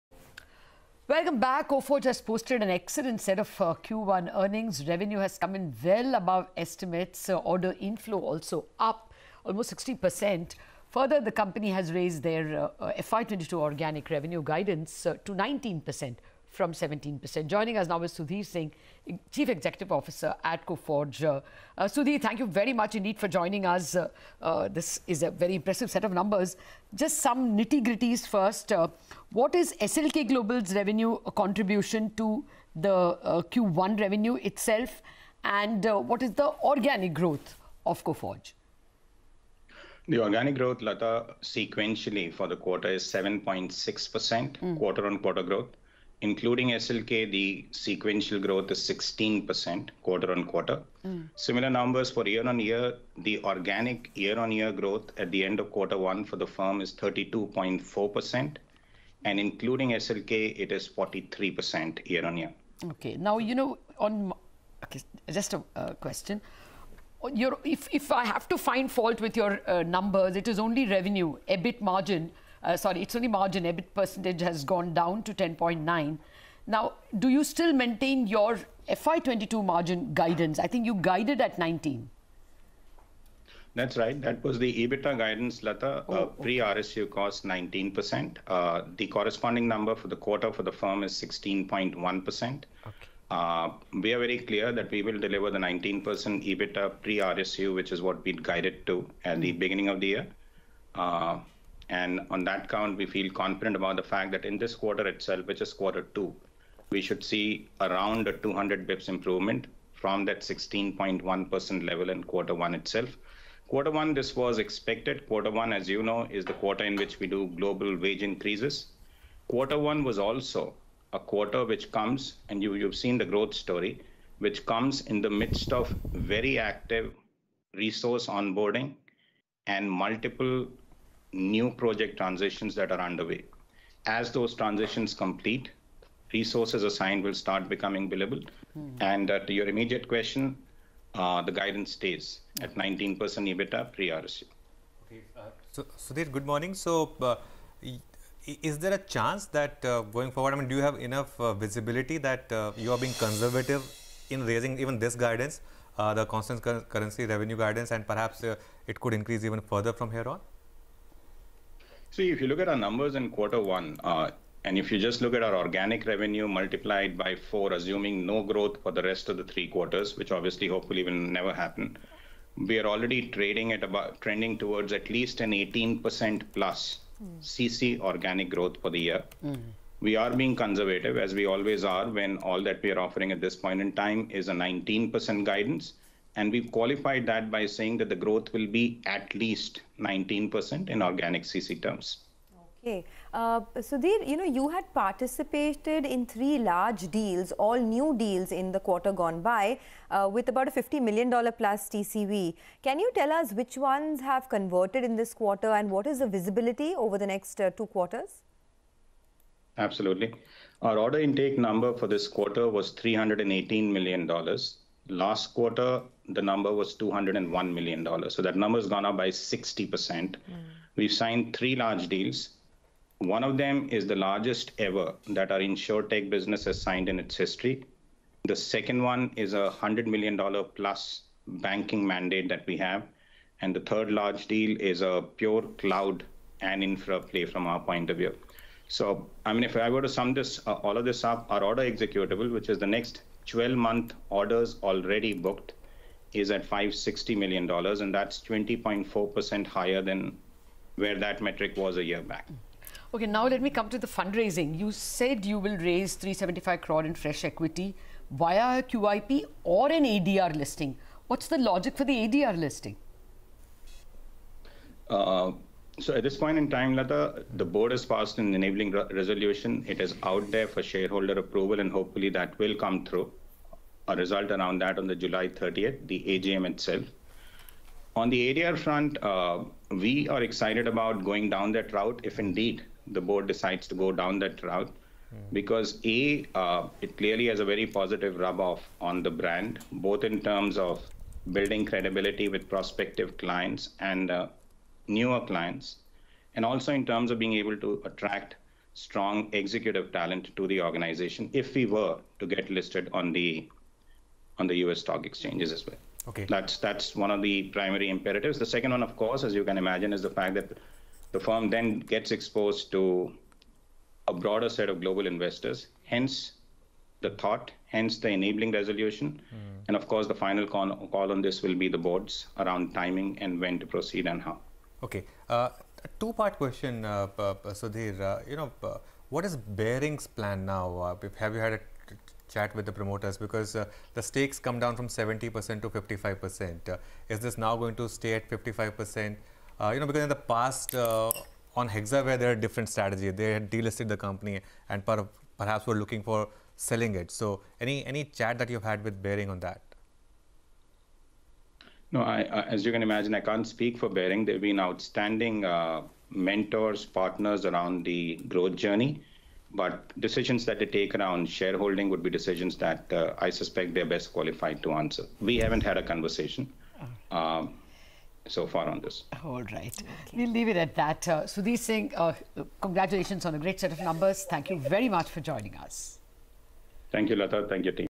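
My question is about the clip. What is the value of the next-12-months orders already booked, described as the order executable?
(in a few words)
$560 million.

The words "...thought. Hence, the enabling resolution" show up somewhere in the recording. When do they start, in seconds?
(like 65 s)
317 s.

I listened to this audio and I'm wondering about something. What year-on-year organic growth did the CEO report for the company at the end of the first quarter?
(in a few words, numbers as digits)
32.4%.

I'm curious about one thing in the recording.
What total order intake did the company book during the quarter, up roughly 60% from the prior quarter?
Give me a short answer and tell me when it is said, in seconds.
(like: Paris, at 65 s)
$318 million, at 212 s.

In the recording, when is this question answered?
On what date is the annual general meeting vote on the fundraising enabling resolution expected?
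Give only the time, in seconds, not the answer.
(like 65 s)
275 s.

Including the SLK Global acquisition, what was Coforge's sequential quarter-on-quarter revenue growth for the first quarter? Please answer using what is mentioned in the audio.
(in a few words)
16%.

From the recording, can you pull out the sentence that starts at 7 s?
Uh, order inflow also up almost 60%.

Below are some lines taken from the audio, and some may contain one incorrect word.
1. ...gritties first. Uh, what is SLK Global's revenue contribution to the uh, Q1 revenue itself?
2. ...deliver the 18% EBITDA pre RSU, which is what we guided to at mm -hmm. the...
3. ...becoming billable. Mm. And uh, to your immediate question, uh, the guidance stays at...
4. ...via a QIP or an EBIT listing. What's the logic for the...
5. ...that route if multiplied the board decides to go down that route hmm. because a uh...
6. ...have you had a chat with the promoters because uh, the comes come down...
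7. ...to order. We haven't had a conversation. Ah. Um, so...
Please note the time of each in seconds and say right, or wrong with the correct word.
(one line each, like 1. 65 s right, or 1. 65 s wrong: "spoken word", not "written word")
1. 27 s right
2. 95 s wrong: "19", not "18"
3. 137 s right
4. 258 s wrong: "ADR", not "EBIT"
5. 281 s wrong: "indeed", not "multiplied"
6. 331 s wrong: "stakes", not "comes"
7. 364 s wrong: "answer", not "order".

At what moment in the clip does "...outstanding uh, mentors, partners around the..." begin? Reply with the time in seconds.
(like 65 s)
354 s.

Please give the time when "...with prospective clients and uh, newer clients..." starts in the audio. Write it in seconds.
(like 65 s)
292 s.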